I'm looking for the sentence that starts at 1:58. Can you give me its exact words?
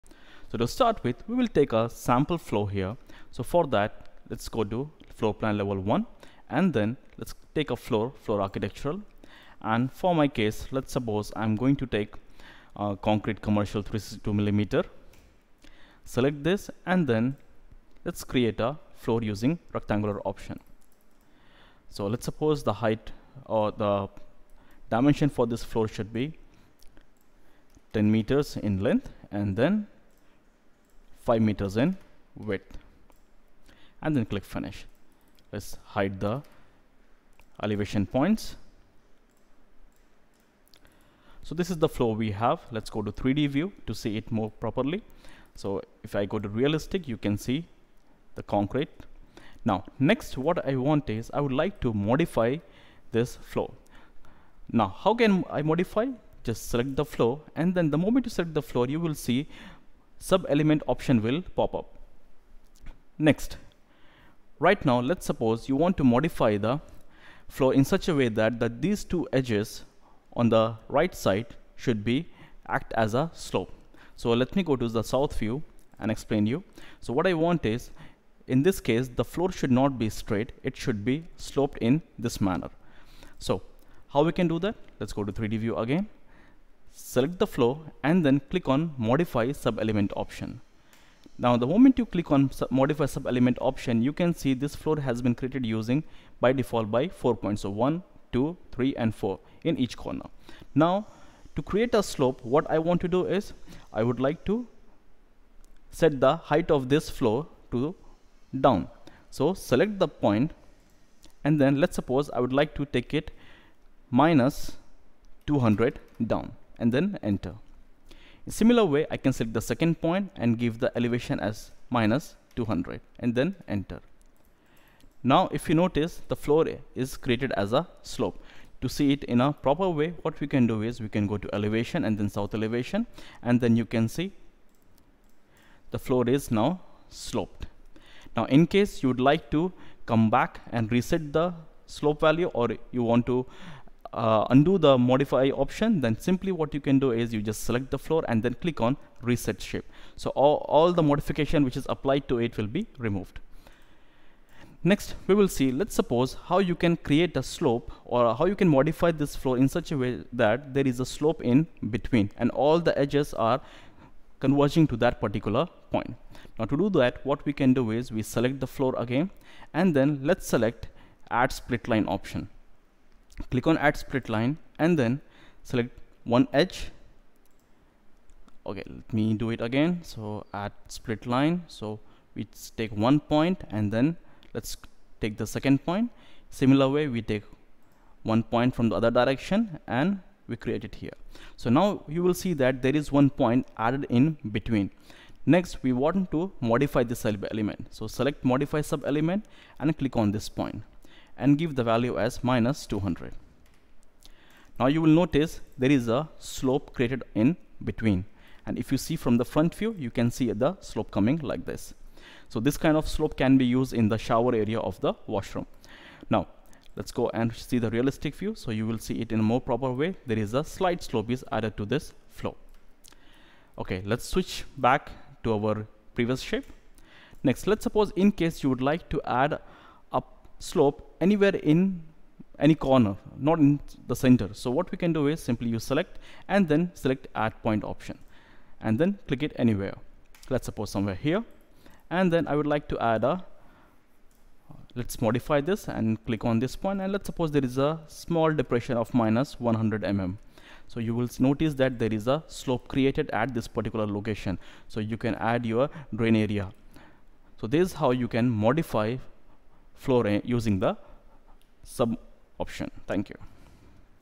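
In similar way, I can select the second point and give the elevation as minus 200 and then enter.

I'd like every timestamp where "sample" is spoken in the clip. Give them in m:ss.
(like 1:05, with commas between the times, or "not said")
0:01.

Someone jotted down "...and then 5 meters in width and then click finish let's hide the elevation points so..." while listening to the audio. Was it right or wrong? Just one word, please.
right.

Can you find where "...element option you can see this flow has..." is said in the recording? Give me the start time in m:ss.
1:33.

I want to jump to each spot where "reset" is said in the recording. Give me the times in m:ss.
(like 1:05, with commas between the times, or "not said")
2:20, 2:29.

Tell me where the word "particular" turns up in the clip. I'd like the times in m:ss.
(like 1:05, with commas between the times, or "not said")
2:45, 4:13.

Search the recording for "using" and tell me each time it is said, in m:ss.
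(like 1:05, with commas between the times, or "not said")
0:19, 1:35, 4:20.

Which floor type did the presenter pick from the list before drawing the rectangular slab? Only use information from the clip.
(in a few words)
Concrete commercial 362 millimeter.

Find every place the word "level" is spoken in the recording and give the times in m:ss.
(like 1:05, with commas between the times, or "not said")
0:05.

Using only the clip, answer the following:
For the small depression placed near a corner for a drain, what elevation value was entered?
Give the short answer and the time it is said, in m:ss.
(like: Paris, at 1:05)
-100 mm, at 4:09.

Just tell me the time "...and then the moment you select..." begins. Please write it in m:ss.
0:57.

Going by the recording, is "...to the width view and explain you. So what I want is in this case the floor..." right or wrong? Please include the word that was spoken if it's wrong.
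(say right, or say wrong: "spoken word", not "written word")
wrong: "south", not "width".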